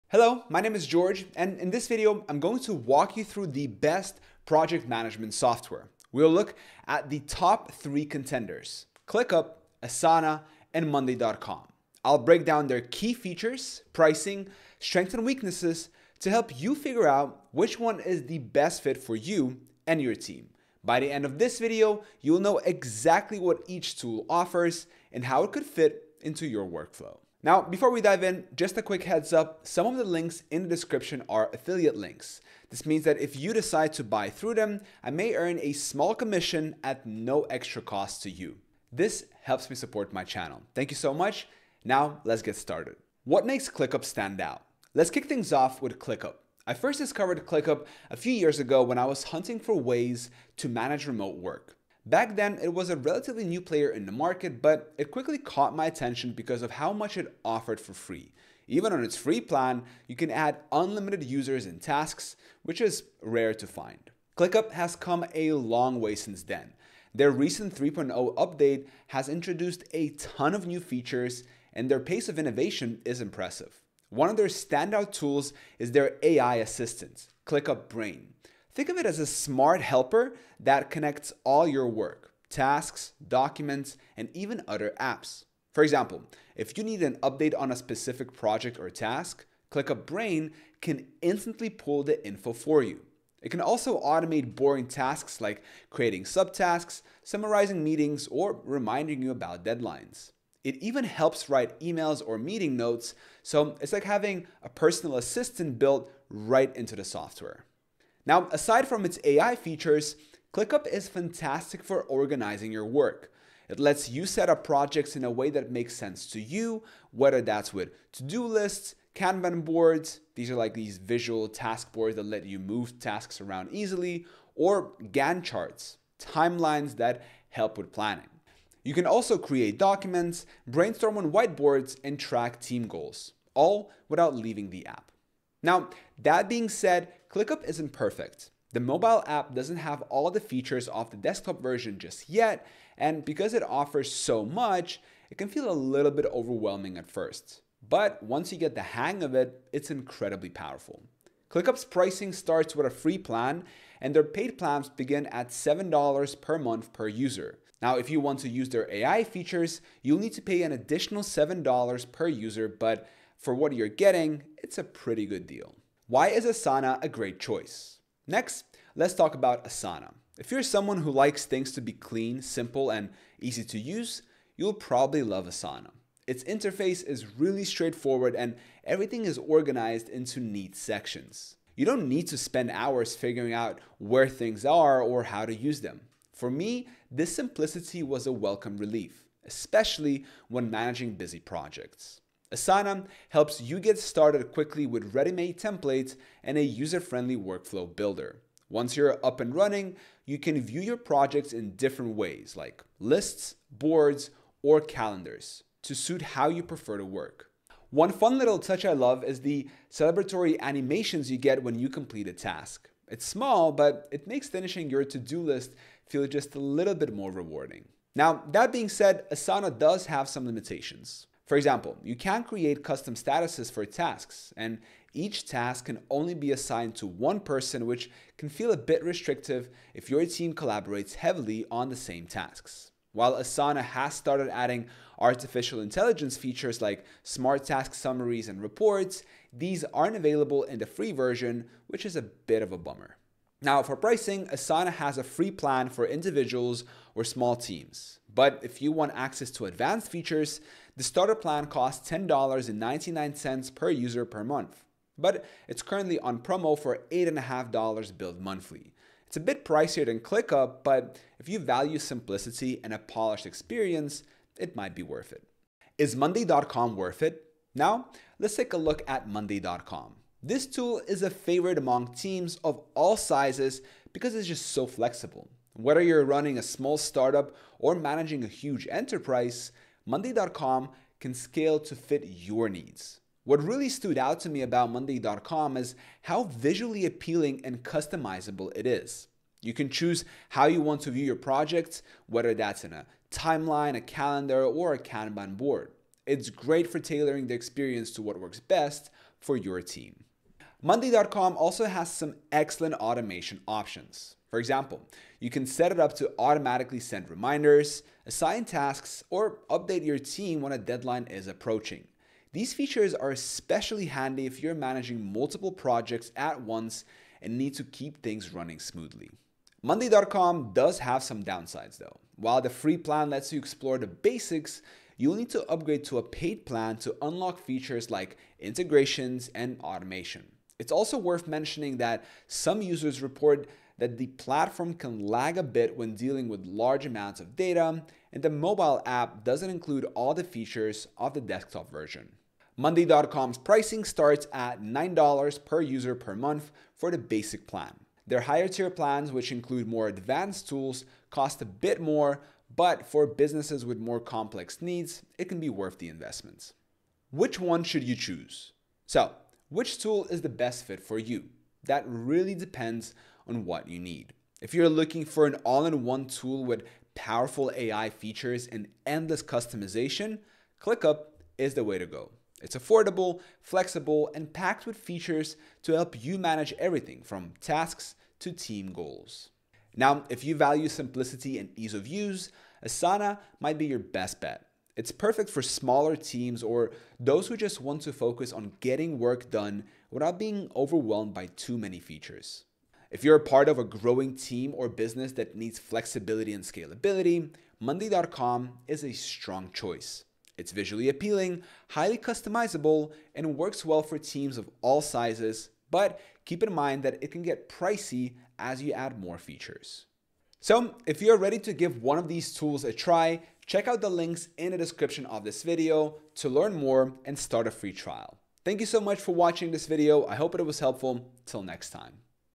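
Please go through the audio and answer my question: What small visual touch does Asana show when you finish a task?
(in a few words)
celebratory animations.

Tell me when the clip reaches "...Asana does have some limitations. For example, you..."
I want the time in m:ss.
3:39.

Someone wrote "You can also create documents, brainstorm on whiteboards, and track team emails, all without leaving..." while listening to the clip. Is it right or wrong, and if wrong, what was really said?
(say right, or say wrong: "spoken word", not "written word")
wrong: "goals", not "emails".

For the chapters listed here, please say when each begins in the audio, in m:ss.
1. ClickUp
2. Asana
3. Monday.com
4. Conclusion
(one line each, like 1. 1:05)
1. 0:43
2. 2:45
3. 4:25
4. 5:57.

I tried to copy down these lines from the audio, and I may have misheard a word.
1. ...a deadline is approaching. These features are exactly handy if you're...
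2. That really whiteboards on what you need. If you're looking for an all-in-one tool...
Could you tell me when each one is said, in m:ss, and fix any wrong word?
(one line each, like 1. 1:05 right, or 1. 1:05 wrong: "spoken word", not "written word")
1. 5:10 wrong: "especially", not "exactly"
2. 6:01 wrong: "depends", not "whiteboards".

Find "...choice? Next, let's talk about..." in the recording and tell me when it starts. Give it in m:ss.
2:47.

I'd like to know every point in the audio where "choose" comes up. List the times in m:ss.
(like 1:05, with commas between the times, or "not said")
4:49, 5:58.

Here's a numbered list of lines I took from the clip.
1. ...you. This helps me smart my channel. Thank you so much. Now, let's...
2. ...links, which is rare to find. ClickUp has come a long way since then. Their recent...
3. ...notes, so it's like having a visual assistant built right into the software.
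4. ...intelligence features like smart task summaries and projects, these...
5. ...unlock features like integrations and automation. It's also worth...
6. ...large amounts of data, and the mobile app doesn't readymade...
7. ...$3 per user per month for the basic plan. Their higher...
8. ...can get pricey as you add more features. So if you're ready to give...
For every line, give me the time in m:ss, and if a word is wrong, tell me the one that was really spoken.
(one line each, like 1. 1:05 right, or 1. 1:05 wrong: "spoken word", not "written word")
1. 0:38 wrong: "support", not "smart"
2. 1:01 wrong: "tasks", not "links"
3. 1:42 wrong: "personal", not "visual"
4. 3:55 wrong: "reports", not "projects"
5. 5:27 right
6. 5:36 wrong: "include", not "readymade"
7. 5:44 wrong: "9", not "3"
8. 6:47 right.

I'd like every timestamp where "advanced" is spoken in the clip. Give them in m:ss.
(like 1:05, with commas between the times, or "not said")
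4:09, 5:50.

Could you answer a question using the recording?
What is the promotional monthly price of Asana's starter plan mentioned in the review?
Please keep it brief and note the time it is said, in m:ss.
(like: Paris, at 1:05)
$8.50, at 4:17.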